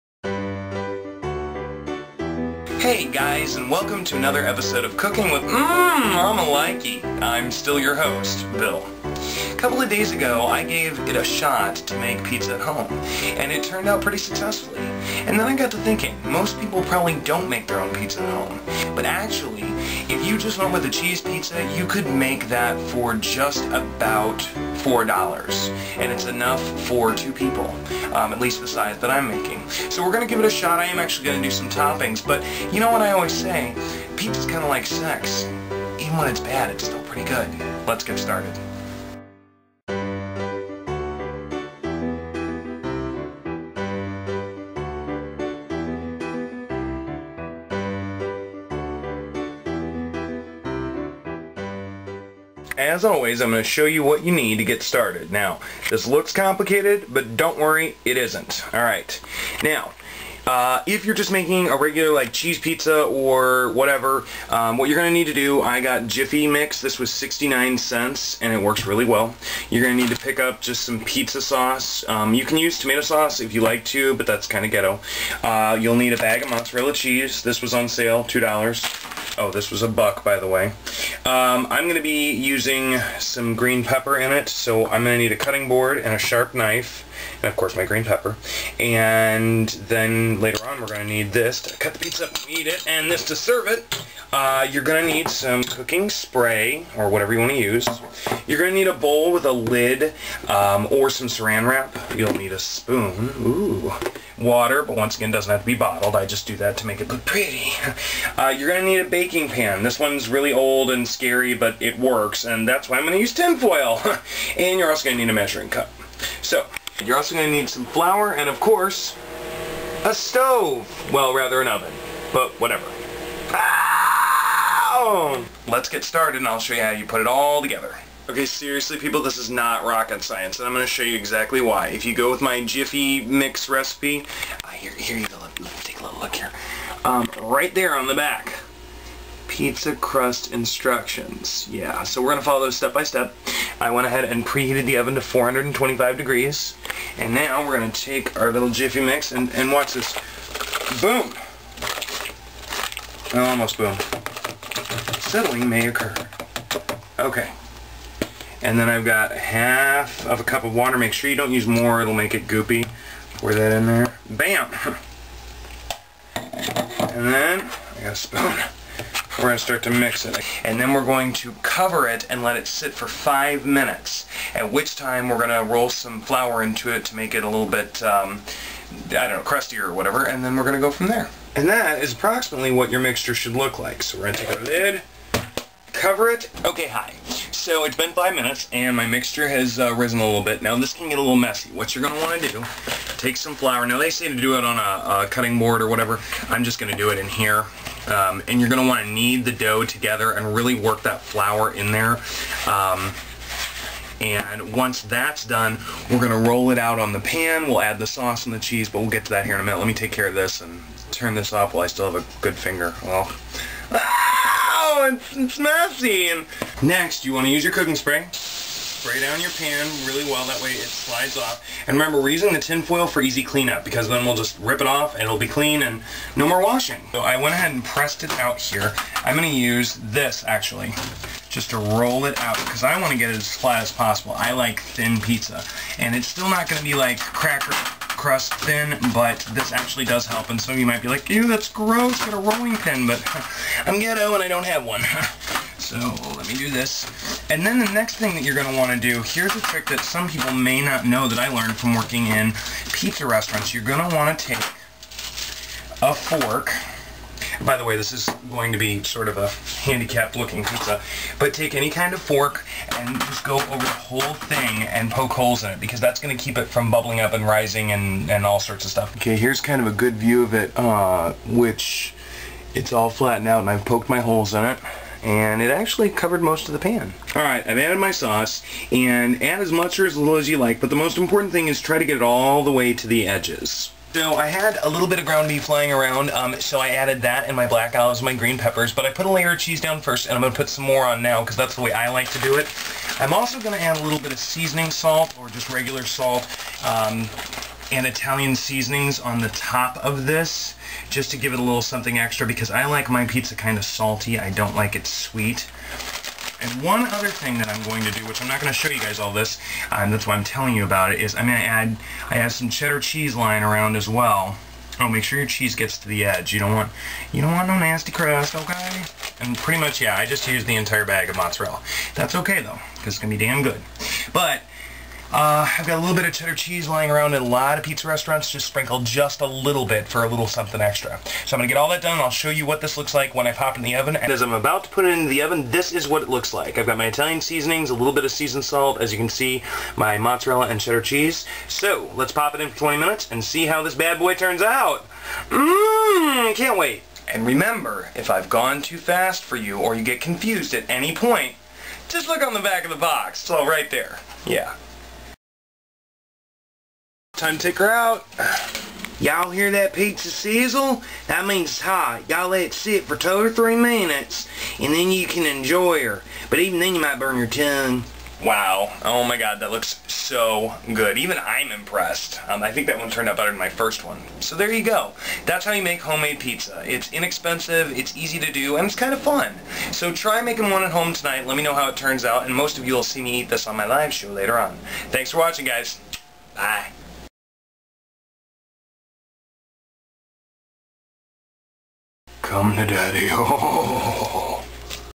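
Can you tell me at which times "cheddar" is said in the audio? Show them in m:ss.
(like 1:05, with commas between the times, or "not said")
5:12, 5:26, 5:40.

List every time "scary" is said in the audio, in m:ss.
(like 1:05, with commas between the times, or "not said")
1:51.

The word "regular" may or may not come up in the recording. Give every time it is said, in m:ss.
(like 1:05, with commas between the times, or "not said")
1:01, 4:55.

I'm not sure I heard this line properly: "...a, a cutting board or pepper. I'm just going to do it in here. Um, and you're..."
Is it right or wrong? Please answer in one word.
wrong.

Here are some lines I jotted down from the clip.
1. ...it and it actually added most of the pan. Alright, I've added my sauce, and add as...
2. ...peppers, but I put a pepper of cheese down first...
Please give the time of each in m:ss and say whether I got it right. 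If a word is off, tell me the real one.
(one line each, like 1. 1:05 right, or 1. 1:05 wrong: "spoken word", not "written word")
1. 4:34 wrong: "covered", not "added"
2. 4:48 wrong: "layer", not "pepper".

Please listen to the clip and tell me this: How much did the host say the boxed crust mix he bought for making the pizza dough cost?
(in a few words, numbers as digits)
69 cents.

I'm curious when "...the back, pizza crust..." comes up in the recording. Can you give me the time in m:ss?
2:18.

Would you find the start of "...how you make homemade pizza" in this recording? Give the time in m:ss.
6:15.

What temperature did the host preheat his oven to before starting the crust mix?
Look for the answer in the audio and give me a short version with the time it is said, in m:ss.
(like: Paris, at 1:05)
425 degrees, at 2:25.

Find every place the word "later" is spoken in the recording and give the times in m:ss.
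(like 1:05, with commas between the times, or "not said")
1:30, 6:24.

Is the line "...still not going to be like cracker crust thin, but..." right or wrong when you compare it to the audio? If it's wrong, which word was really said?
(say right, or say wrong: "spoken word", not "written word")
right.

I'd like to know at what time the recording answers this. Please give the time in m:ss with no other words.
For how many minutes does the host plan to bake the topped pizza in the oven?
5:42.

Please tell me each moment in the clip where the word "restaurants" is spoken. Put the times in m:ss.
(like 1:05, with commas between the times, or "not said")
4:13, 5:28.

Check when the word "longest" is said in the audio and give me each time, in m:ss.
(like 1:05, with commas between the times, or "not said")
not said.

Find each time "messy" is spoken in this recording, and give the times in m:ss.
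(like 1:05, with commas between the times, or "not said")
3:11, 3:35.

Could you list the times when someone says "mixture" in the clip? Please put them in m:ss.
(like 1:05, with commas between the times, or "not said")
3:02, 3:09.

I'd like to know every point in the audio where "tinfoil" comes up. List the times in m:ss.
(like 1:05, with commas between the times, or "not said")
1:53, 3:42.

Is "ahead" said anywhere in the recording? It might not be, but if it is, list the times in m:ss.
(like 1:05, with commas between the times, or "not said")
2:24, 3:47.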